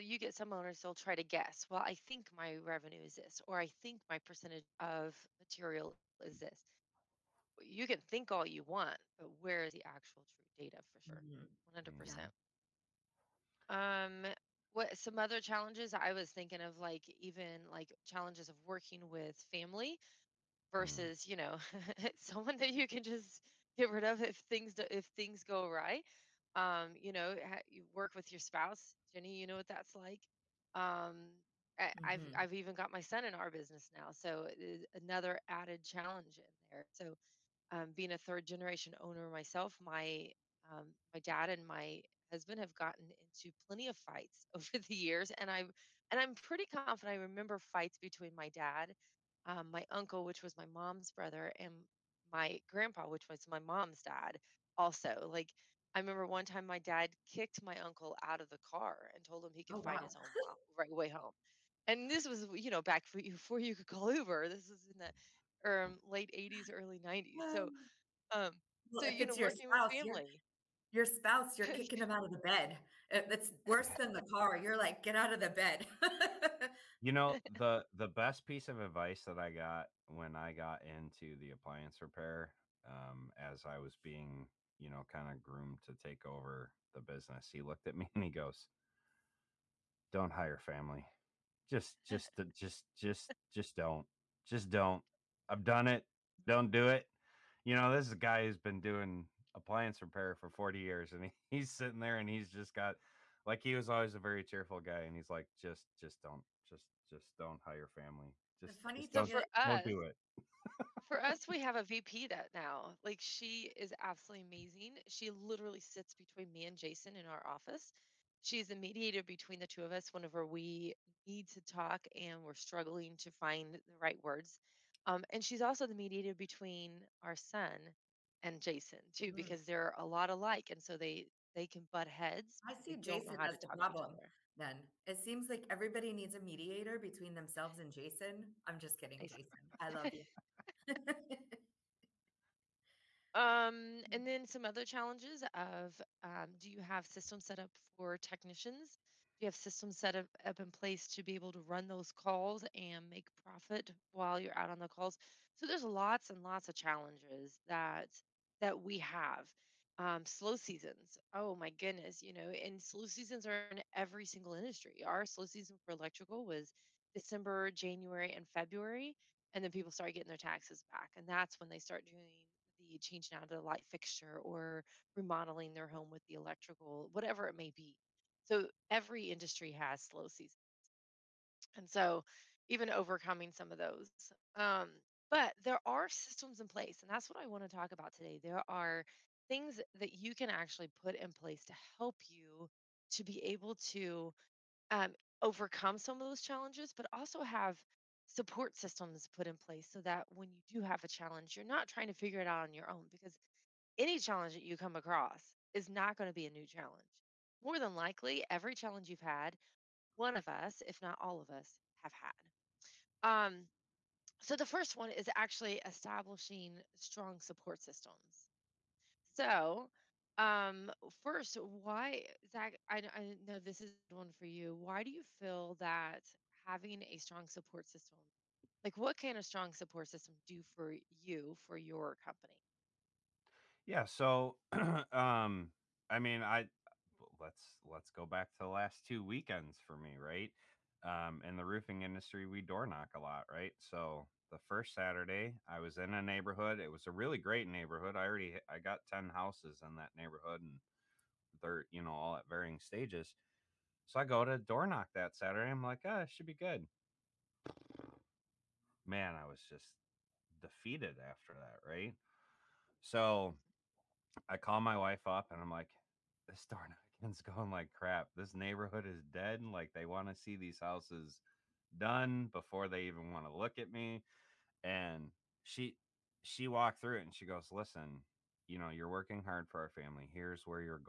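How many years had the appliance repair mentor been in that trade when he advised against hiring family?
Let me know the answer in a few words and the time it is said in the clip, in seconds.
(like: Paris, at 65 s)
40, at 100 s.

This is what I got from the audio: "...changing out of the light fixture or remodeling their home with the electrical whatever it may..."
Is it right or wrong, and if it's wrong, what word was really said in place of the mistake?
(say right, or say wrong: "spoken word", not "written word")
right.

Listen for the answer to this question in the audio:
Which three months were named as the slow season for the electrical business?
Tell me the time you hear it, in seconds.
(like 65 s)
167 s.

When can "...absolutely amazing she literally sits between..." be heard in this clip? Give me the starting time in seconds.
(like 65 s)
113 s.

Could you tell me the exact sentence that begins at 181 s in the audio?
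And so even overcoming some of those.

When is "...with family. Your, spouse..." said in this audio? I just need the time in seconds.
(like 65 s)
69 s.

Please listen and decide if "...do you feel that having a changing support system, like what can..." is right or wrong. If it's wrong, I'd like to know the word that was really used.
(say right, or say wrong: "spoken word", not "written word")
wrong: "strong", not "changing".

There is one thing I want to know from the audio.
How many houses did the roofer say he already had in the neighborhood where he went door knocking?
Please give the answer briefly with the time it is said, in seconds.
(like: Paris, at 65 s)
10, at 249 s.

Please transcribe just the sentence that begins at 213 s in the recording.
Um, so the first one is actually establishing strong support systems.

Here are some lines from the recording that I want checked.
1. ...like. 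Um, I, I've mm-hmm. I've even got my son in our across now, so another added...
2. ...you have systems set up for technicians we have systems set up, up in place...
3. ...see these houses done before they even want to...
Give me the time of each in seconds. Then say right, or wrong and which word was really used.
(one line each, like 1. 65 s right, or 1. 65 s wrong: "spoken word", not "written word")
1. 29 s wrong: "business", not "across"
2. 146 s right
3. 270 s right.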